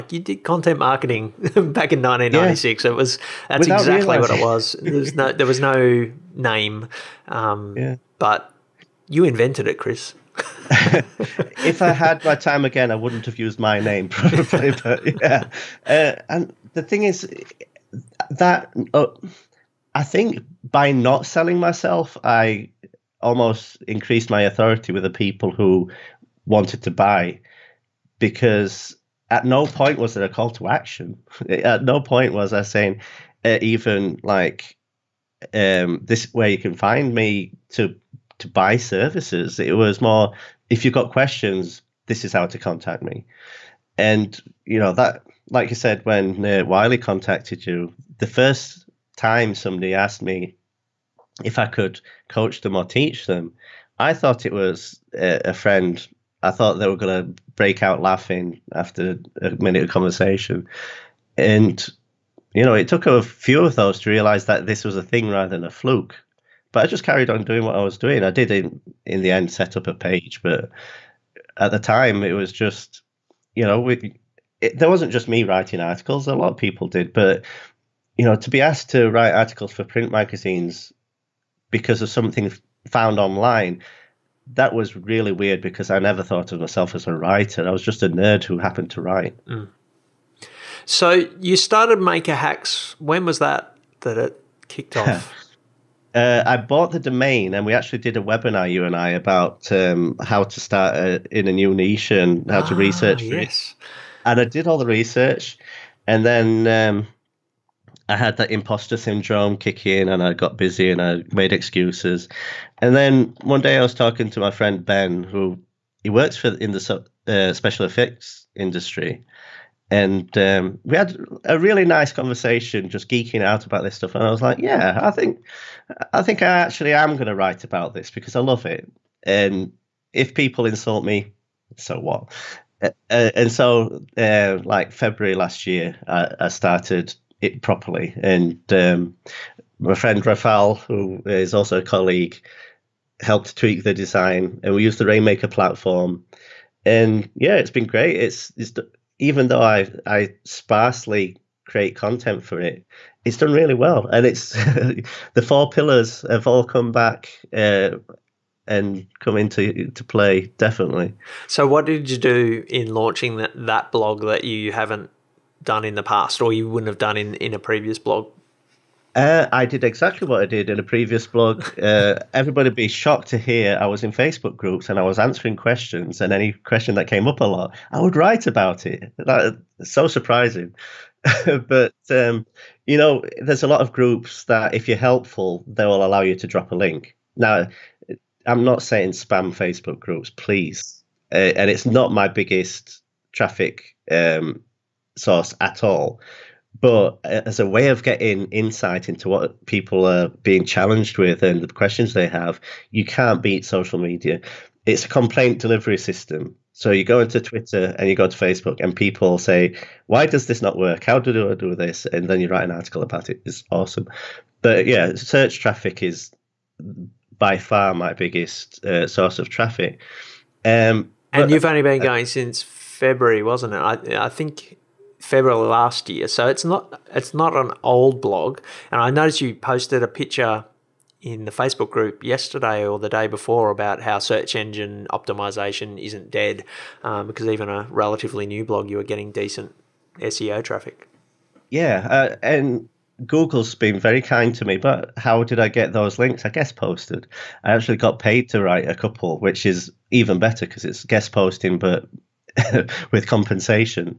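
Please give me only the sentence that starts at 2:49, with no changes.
Uh, I did exactly what I did in a previous blog.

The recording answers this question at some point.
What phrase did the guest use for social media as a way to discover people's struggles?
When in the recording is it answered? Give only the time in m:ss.
3:25.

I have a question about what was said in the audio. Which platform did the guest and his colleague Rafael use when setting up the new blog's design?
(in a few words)
Rainmaker.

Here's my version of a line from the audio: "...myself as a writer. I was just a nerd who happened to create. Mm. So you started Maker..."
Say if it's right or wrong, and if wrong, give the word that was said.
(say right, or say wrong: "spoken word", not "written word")
wrong: "write", not "create".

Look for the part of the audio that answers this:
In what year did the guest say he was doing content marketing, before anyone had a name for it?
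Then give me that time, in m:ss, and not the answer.
0:02.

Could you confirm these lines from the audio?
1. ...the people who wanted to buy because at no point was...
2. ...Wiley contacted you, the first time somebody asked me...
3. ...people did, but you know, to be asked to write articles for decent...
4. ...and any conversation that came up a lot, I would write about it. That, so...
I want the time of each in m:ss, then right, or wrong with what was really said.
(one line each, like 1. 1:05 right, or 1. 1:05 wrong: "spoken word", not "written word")
1. 0:25 right
2. 0:46 right
3. 1:16 wrong: "print", not "decent"
4. 2:56 wrong: "question", not "conversation".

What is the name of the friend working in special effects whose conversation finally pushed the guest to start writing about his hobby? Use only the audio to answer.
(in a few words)
Ben.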